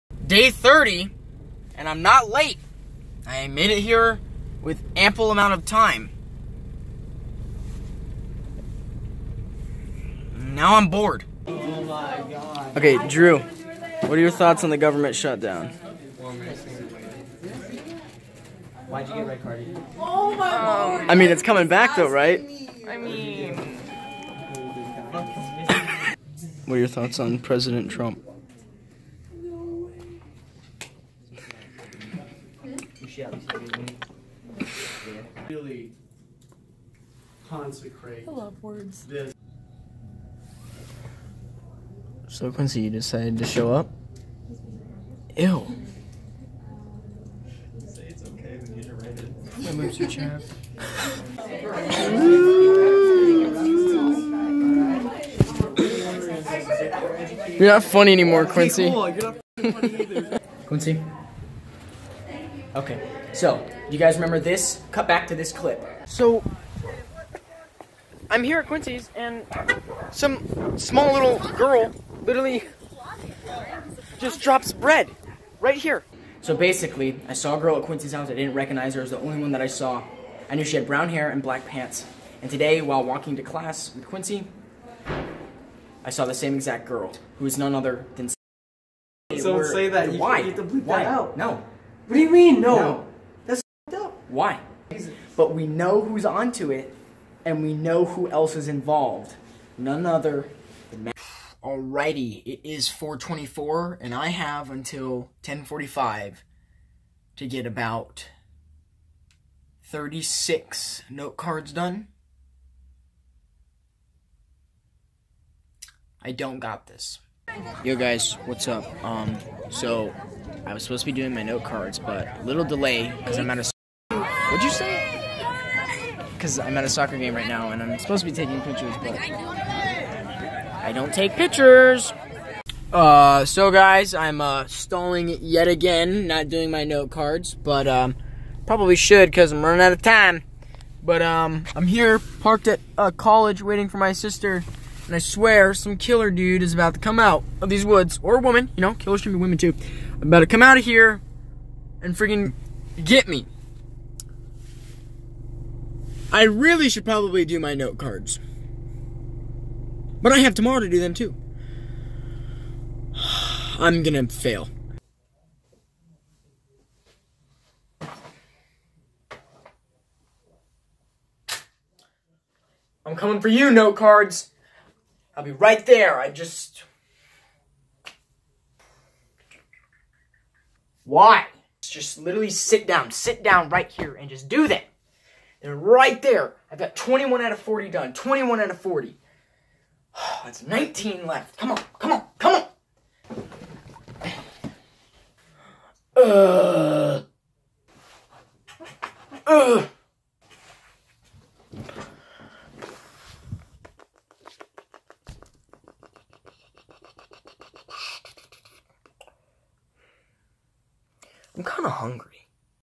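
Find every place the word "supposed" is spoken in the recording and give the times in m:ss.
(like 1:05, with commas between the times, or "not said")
2:00, 2:07.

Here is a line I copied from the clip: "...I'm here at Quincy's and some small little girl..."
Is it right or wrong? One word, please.
right.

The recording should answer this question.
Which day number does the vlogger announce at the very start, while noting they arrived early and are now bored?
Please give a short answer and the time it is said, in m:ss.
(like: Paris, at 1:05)
30, at 0:00.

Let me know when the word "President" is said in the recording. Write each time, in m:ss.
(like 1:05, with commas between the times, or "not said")
0:27.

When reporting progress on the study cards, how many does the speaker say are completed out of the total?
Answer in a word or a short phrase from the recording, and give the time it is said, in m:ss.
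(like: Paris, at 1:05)
21, at 3:06.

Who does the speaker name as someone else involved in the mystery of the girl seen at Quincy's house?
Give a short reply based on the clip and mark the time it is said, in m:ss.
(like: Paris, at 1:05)
Matt, at 1:41.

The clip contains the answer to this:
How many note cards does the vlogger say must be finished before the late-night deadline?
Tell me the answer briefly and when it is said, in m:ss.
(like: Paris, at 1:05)
36, at 1:49.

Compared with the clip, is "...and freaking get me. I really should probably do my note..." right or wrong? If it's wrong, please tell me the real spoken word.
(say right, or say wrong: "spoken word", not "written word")
right.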